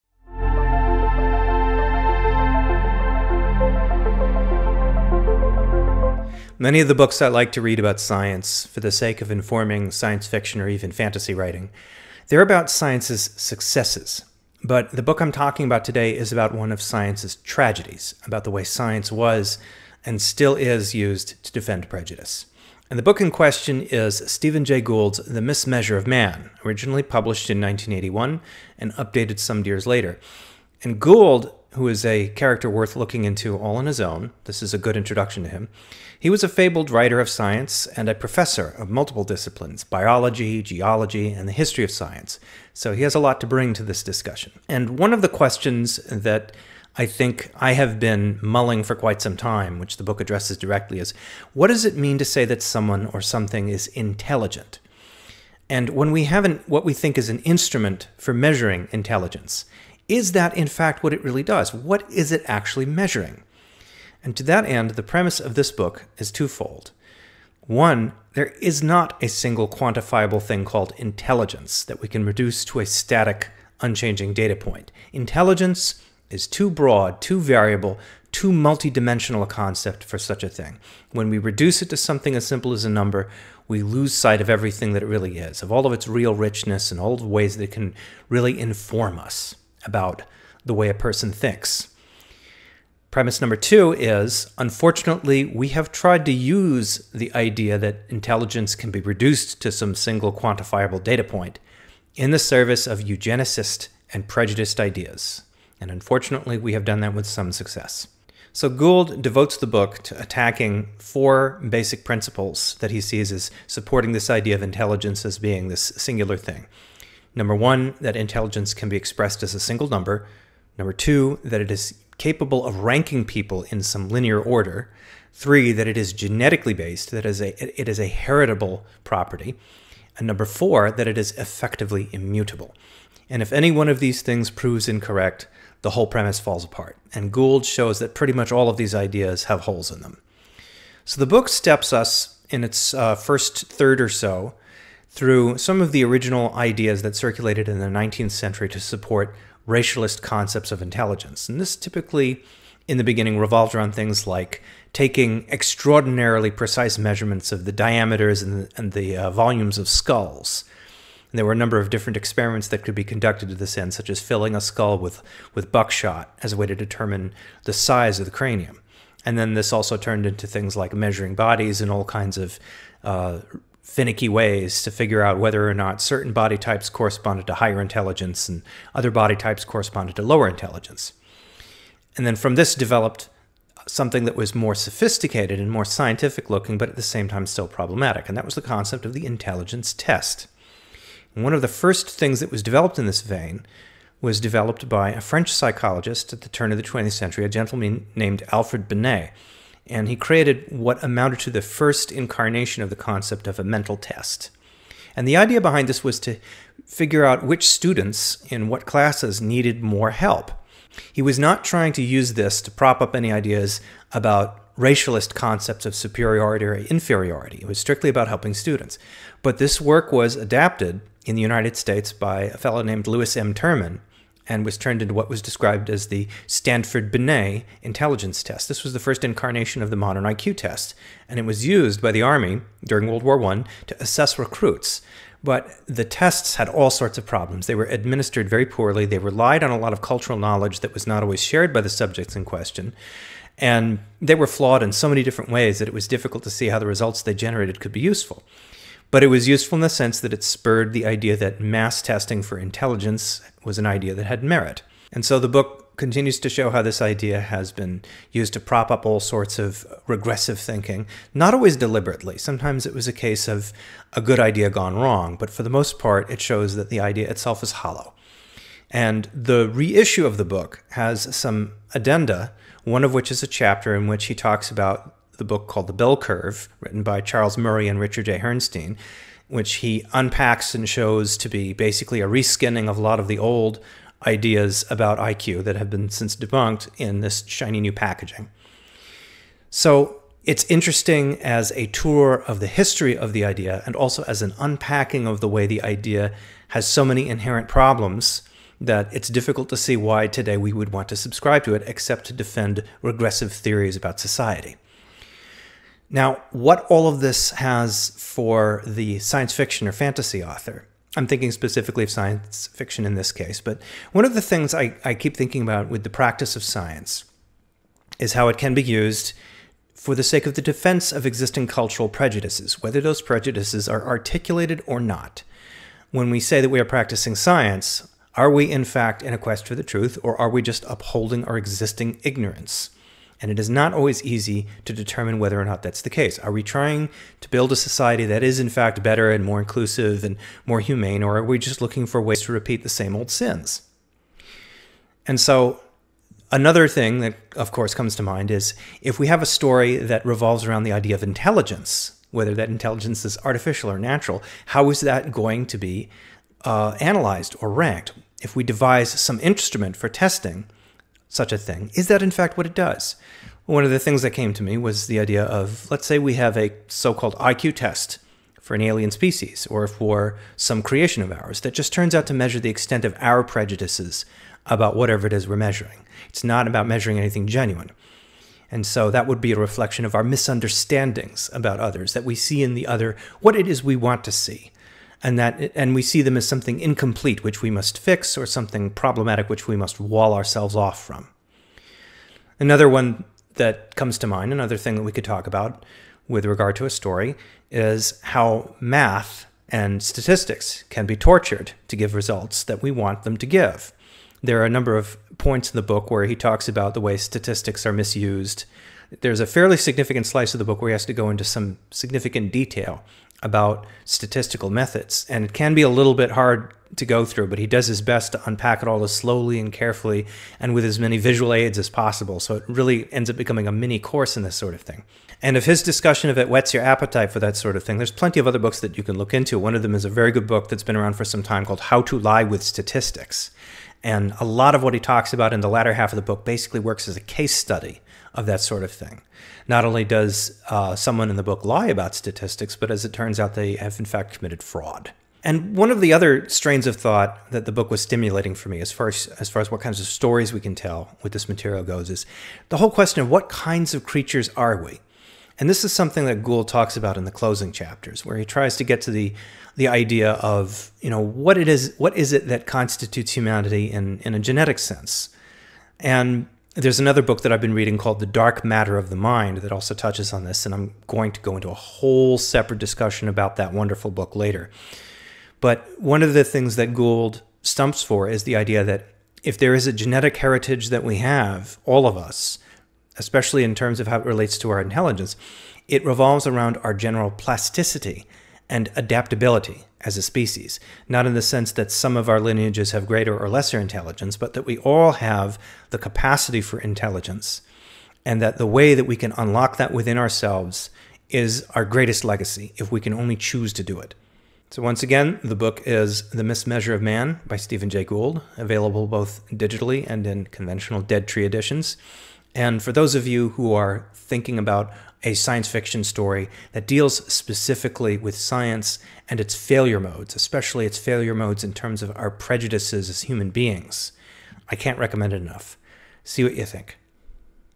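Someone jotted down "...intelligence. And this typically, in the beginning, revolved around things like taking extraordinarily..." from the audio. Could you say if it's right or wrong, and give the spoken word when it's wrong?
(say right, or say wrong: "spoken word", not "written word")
right.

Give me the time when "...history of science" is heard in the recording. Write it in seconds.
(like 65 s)
41 s.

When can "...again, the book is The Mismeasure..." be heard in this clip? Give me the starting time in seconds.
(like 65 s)
505 s.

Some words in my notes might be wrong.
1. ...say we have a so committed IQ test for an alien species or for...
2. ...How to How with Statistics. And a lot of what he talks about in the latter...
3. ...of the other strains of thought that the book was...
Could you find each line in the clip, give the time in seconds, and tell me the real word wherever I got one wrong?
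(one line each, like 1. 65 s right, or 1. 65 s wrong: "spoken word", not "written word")
1. 366 s wrong: "called", not "committed"
2. 431 s wrong: "Lie", not "How"
3. 445 s right.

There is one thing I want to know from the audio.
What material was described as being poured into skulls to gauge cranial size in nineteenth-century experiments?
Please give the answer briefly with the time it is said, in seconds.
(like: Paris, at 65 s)
buckshot, at 165 s.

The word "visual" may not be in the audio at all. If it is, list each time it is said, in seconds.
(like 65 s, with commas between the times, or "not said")
421 s.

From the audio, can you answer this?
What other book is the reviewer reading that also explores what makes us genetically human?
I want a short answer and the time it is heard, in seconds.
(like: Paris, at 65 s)
The Dark Matter of the Mind, at 468 s.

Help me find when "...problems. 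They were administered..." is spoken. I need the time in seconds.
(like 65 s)
237 s.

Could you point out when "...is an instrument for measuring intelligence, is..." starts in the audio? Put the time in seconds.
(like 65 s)
57 s.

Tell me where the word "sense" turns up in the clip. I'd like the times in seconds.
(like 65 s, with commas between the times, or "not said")
249 s, 464 s, 491 s.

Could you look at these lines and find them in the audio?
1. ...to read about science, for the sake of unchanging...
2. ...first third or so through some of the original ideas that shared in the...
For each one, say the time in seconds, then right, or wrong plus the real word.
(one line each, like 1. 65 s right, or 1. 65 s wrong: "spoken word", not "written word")
1. 7 s wrong: "informing", not "unchanging"
2. 143 s wrong: "circulated", not "shared".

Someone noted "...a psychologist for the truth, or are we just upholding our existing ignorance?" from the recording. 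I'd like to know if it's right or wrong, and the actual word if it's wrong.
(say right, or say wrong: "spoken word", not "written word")
wrong: "quest", not "psychologist".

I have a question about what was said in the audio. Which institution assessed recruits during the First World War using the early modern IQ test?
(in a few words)
the Army.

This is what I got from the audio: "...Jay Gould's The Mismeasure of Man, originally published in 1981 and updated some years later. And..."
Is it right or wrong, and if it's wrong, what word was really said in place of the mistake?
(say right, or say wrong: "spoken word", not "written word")
right.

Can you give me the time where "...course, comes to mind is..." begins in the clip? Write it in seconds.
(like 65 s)
347 s.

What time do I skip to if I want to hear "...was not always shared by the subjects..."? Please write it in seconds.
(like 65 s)
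240 s.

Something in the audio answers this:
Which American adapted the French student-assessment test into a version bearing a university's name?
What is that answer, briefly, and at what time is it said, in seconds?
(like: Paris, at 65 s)
Lewis M. Terman, at 223 s.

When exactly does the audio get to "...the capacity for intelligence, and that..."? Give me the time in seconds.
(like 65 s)
495 s.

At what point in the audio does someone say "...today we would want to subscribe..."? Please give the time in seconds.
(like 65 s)
300 s.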